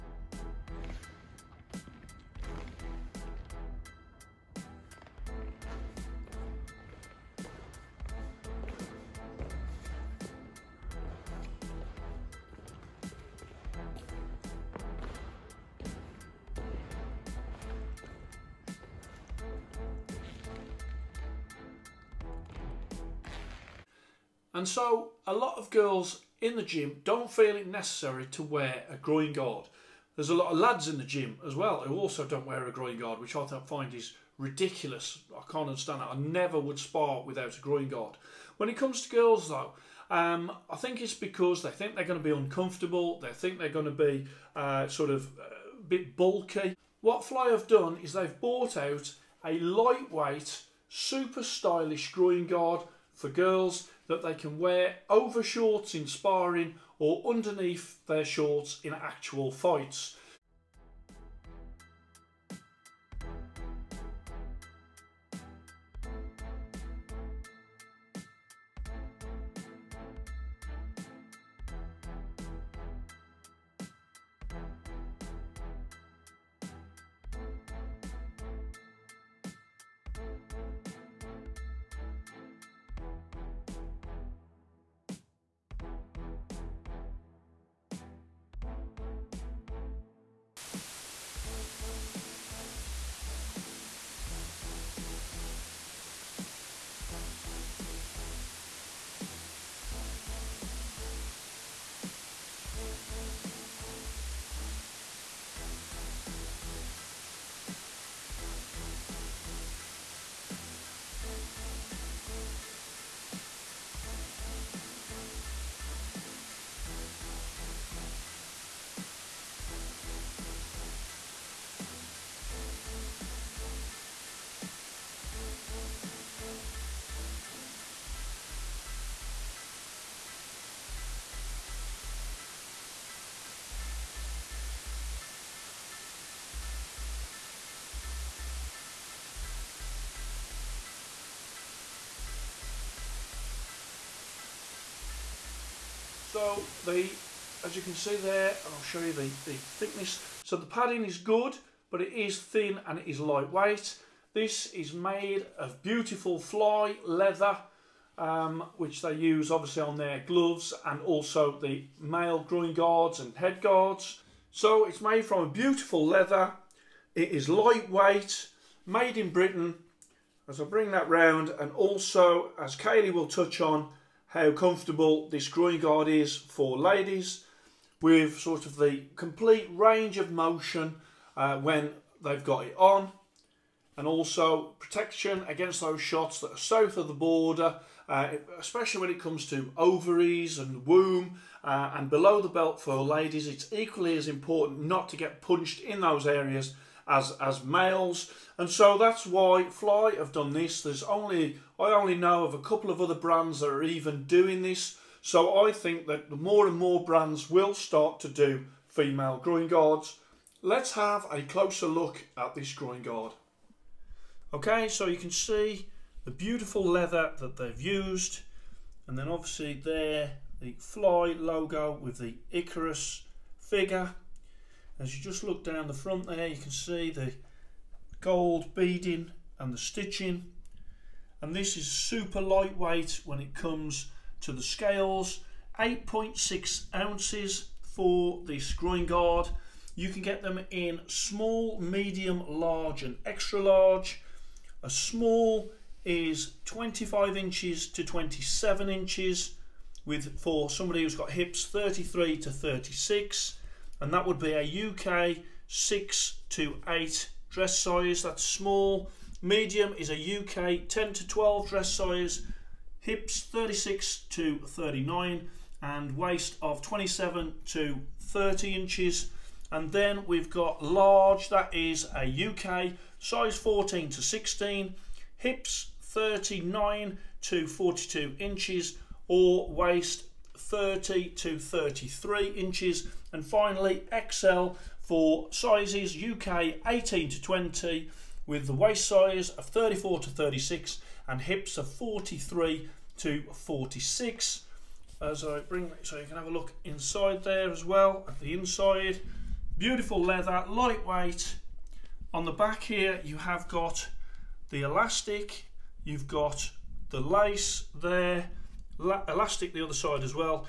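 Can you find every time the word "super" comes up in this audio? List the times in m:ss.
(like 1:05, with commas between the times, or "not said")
0:50, 3:51.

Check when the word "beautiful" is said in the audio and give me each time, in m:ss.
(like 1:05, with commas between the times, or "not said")
2:35, 2:45, 3:36, 4:59.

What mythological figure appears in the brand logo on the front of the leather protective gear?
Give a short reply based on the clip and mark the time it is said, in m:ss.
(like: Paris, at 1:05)
Icarus, at 3:42.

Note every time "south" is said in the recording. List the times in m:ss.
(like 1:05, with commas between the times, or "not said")
3:06.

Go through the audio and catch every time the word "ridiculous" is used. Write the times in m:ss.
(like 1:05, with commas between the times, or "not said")
0:34.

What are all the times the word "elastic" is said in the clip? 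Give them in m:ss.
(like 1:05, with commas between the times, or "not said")
5:04, 5:08.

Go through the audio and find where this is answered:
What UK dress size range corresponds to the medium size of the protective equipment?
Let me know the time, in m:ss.
4:20.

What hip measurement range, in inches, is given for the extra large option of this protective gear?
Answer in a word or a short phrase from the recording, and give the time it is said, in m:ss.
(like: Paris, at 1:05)
43 to 46, at 4:51.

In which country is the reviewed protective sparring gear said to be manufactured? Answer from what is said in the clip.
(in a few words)
Britain.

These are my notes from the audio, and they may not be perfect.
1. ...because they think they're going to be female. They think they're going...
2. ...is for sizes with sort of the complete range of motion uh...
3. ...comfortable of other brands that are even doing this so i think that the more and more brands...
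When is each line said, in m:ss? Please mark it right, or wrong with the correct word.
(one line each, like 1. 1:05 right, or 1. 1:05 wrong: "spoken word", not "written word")
1. 0:41 wrong: "uncomfortable", not "female"
2. 2:56 wrong: "ladies", not "sizes"
3. 3:22 wrong: "couple", not "comfortable".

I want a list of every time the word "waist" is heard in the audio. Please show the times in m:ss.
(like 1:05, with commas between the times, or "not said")
4:26, 4:39, 4:48.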